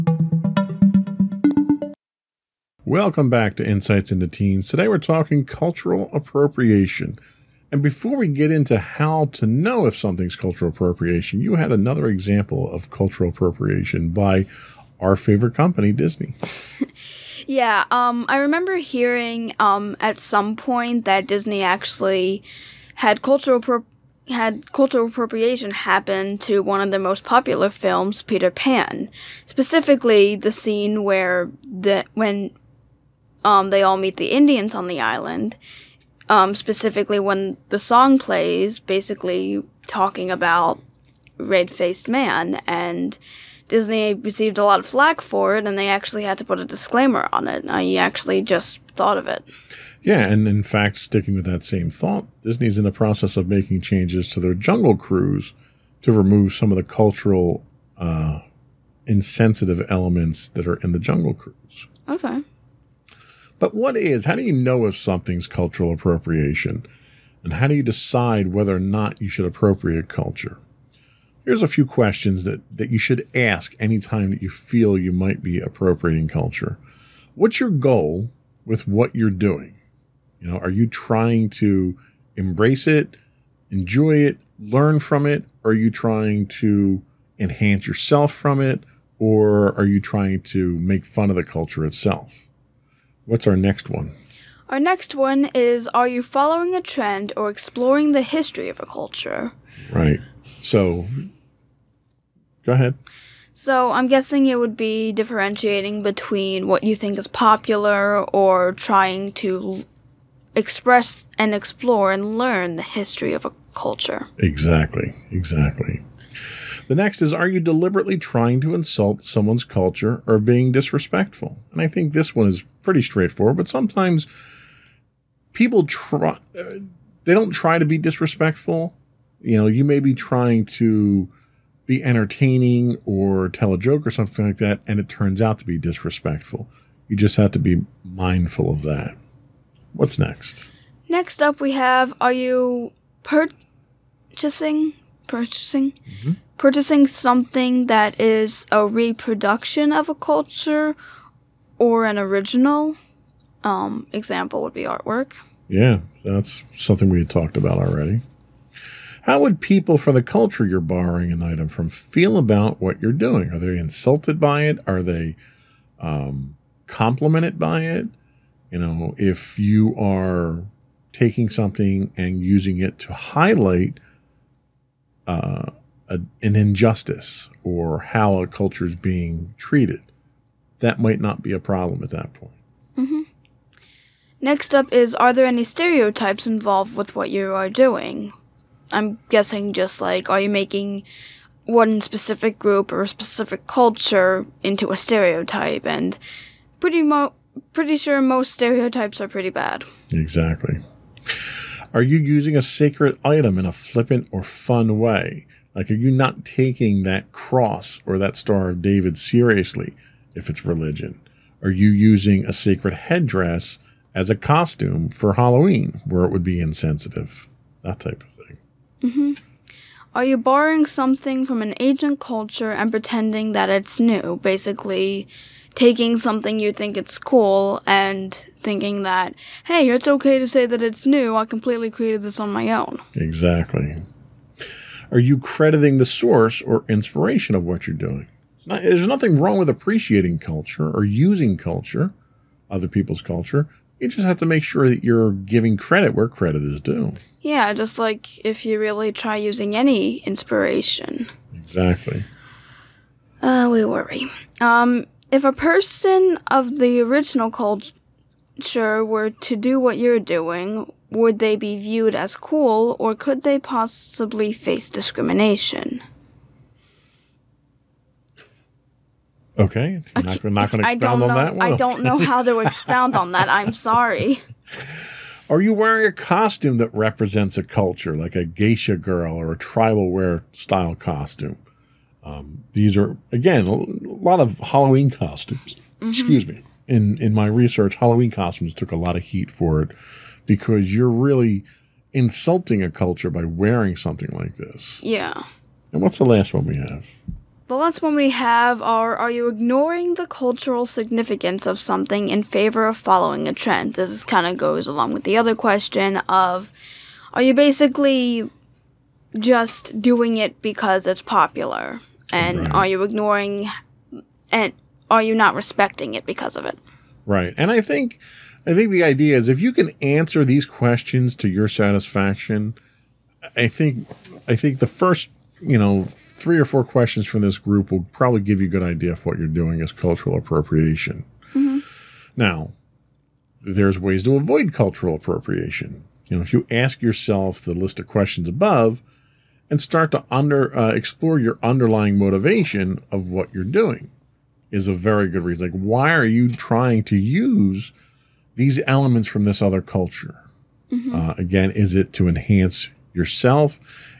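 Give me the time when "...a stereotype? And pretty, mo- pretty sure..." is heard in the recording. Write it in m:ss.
3:14.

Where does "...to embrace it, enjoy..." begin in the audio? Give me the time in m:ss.
1:21.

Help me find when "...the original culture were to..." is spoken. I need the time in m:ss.
4:16.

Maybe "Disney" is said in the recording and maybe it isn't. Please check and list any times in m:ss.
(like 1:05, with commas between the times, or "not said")
0:15, 0:21, 0:43, 0:52.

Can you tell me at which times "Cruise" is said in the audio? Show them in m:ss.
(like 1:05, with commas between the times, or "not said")
0:54, 1:01.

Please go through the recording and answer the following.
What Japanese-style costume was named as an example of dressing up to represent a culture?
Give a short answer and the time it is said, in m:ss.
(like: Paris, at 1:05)
geisha girl, at 4:38.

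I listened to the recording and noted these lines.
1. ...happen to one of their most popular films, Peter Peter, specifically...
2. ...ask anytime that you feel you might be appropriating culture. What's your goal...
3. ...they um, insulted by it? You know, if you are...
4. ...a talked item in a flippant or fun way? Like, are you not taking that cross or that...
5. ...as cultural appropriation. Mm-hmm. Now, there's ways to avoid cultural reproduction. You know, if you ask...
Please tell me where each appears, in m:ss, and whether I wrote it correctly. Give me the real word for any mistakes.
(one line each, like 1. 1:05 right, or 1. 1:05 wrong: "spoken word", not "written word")
1. 0:25 wrong: "Pan", not "Peter"
2. 1:13 right
3. 2:45 wrong: "complimented", not "insulted"
4. 3:22 wrong: "sacred", not "talked"
5. 5:29 wrong: "appropriation", not "reproduction".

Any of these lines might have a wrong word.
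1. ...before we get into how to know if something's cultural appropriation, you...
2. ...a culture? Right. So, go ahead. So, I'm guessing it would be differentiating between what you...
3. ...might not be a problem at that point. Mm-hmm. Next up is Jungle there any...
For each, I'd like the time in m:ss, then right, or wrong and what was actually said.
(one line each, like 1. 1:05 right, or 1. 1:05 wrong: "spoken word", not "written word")
1. 0:07 right
2. 1:38 right
3. 3:00 wrong: "Are", not "Jungle".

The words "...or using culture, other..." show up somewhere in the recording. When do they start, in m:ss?
4:00.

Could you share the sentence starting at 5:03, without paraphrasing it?
This kind of goes along with the other question of Are you basically just doing it because it's popular?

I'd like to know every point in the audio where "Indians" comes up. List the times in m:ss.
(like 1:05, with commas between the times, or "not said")
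0:34.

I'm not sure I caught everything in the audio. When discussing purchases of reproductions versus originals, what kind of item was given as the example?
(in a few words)
artwork.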